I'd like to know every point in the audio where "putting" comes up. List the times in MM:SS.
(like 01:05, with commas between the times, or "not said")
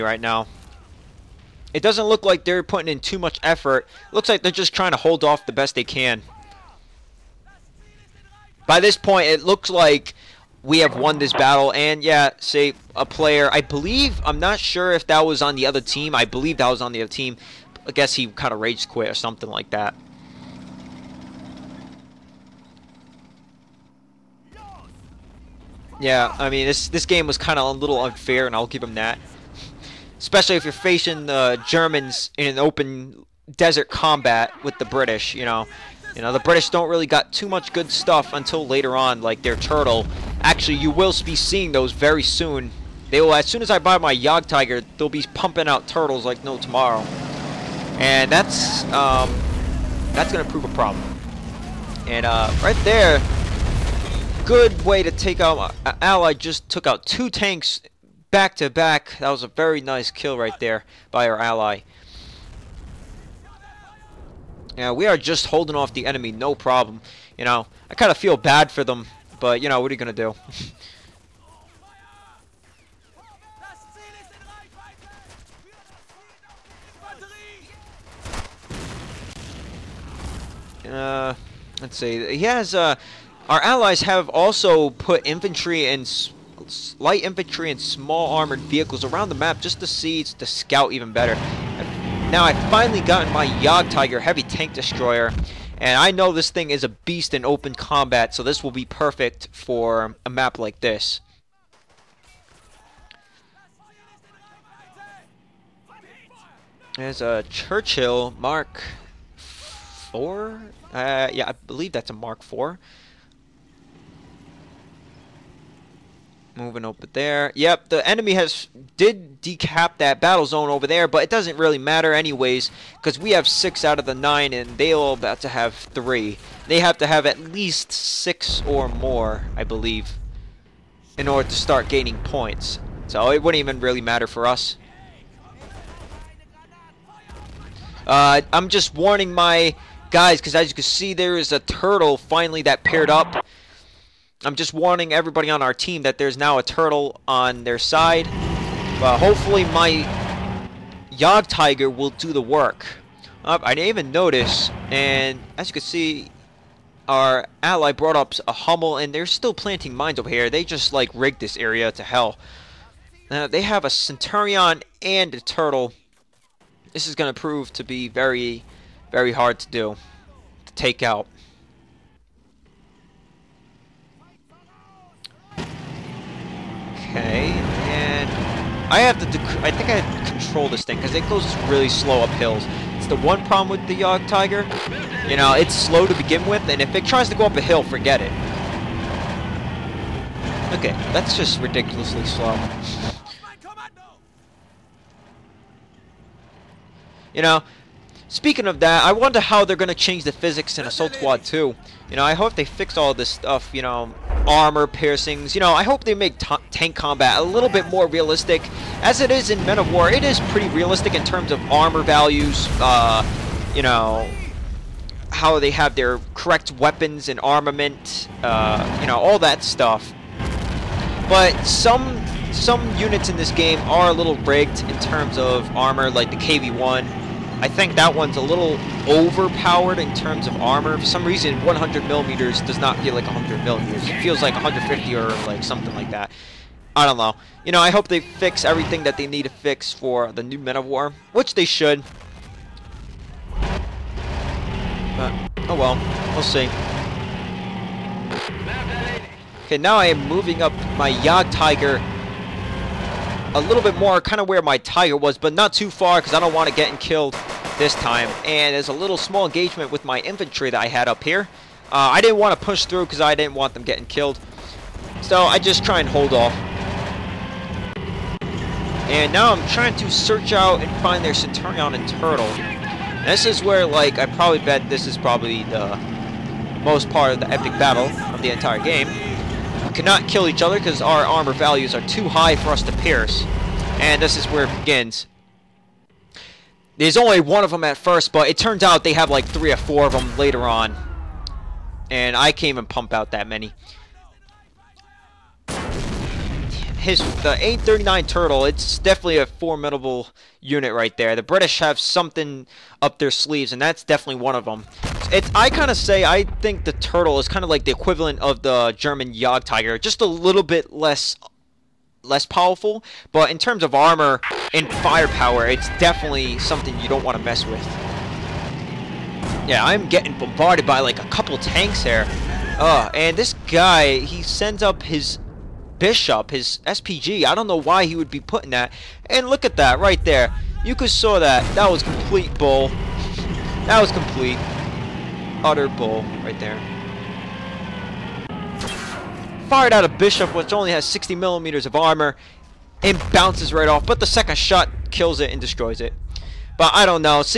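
00:02, 05:28.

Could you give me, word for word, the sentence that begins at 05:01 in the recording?
The British have something up their sleeves, and that's definitely one of them.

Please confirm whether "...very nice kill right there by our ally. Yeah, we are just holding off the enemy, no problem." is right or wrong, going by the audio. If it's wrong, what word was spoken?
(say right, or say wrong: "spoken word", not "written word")
right.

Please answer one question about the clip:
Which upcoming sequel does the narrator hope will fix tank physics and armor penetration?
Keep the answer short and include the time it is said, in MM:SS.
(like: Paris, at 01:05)
Assault Squad 2, at 03:20.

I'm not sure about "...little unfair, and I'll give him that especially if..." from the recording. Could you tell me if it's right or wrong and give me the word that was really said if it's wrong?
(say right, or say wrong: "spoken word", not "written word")
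right.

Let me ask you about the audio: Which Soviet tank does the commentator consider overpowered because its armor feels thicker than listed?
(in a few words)
KV-1.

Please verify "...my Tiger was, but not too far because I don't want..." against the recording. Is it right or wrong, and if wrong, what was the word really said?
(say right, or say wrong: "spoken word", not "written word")
right.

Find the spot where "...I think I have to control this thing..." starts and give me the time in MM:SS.
02:59.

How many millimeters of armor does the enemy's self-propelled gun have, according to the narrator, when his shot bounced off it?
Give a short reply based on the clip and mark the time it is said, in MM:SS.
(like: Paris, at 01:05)
60, at 05:41.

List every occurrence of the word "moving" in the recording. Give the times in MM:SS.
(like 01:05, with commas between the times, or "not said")
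01:56, 04:10.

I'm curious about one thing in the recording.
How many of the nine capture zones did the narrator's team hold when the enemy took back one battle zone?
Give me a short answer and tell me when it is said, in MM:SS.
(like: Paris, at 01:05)
6, at 02:03.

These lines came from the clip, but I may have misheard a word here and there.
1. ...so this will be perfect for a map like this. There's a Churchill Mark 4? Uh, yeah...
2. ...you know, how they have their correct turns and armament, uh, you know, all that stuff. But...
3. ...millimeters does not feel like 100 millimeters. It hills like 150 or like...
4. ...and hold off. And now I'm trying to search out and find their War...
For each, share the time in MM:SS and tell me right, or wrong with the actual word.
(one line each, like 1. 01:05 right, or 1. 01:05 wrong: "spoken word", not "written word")
1. 01:38 right
2. 03:33 wrong: "weapons", not "turns"
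3. 03:52 wrong: "feels", not "hills"
4. 04:25 wrong: "Centurion", not "War".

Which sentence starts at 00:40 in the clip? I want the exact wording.
Actually, you will be seeing those very soon.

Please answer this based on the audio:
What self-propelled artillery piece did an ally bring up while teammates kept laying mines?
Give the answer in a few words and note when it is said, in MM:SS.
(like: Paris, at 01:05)
Hummel, at 02:38.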